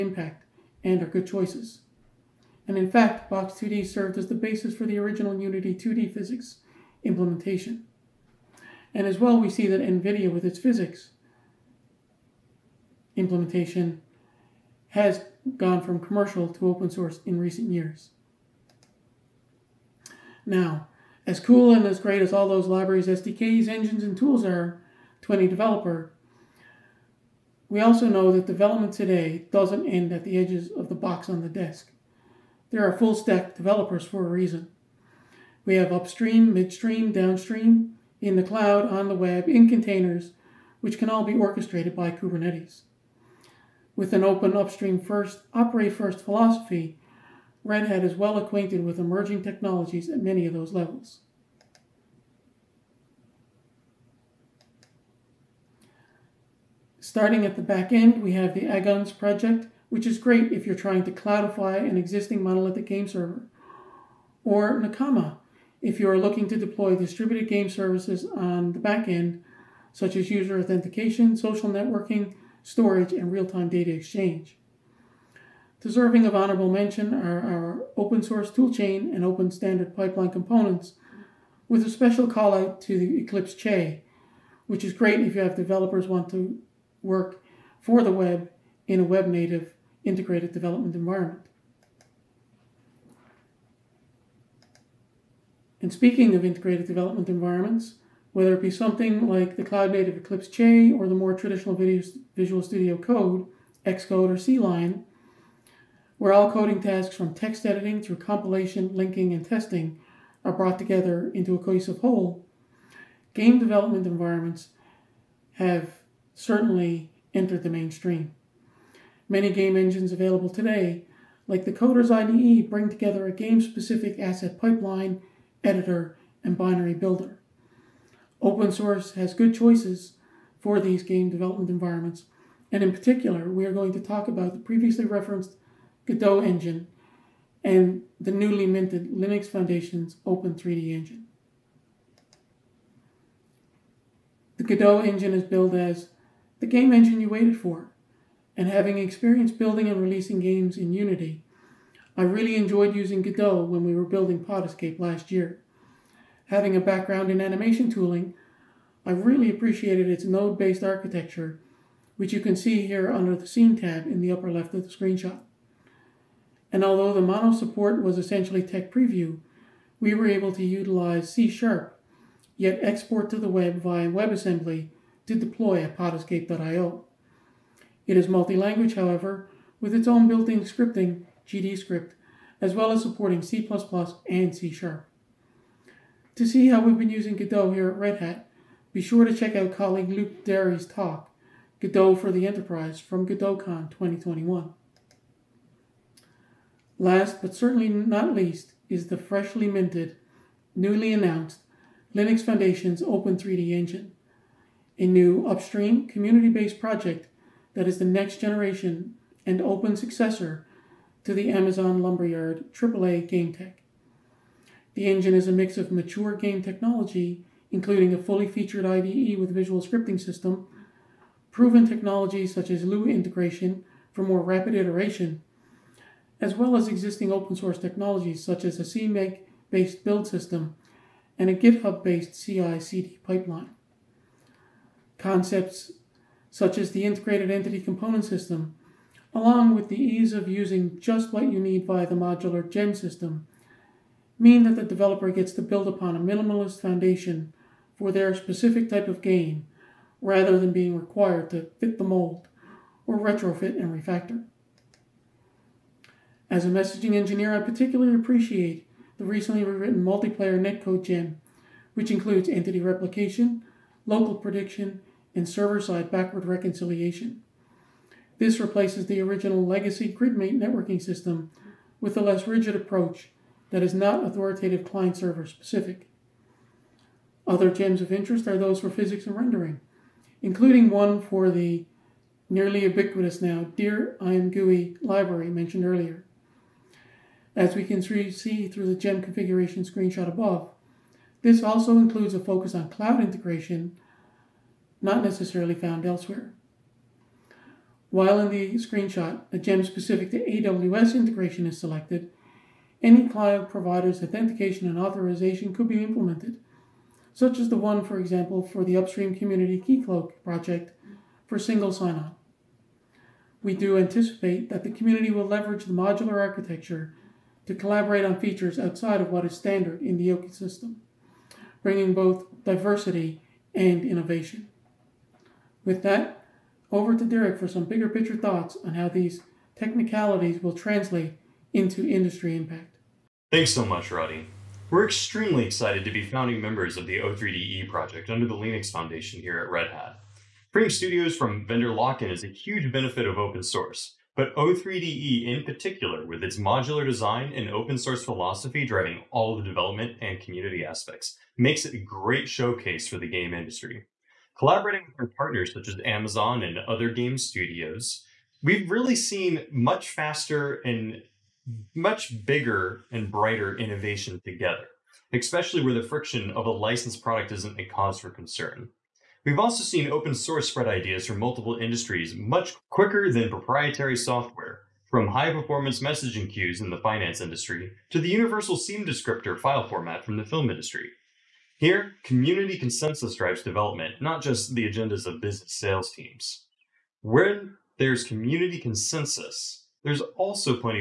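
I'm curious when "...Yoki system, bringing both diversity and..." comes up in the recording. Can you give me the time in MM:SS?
05:20.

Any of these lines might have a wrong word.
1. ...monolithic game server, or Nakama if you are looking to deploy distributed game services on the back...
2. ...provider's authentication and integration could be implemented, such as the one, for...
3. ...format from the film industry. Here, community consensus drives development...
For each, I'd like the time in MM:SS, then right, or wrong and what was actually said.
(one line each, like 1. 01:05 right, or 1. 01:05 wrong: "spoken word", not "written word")
1. 01:02 right
2. 05:03 wrong: "authorization", not "integration"
3. 06:19 right.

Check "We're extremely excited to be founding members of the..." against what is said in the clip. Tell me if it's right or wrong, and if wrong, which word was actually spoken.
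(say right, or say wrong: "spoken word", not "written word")
right.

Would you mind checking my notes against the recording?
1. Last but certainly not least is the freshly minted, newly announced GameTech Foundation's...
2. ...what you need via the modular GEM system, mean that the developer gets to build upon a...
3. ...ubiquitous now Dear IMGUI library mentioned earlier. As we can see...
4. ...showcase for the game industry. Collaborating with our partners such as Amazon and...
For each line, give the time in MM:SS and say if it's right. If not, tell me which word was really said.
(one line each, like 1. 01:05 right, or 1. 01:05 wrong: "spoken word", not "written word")
1. 03:16 wrong: "Linux", not "GameTech"
2. 04:01 right
3. 04:42 right
4. 05:52 right.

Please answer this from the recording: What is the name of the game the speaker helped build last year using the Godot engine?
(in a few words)
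Pod Escape.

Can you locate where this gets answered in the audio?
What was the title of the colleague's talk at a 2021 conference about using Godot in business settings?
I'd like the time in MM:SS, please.
03:11.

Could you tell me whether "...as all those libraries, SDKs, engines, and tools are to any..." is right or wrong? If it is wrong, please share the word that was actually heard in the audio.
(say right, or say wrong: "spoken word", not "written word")
right.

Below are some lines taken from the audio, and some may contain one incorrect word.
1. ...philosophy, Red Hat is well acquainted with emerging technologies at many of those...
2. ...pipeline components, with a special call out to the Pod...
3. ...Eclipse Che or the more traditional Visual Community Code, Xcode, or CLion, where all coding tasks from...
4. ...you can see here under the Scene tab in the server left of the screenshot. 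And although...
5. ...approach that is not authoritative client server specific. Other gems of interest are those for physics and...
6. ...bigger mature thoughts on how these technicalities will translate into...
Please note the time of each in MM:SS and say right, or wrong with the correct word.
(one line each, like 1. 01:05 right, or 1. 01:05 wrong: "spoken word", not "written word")
1. 00:46 right
2. 01:19 wrong: "Eclipse", not "Pod"
3. 01:40 wrong: "Studio", not "Community"
4. 02:42 wrong: "upper", not "server"
5. 04:32 right
6. 05:27 wrong: "picture", not "mature".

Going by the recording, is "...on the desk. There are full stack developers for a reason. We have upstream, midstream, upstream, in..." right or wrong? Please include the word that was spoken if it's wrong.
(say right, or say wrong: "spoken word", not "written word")
wrong: "downstream", not "upstream".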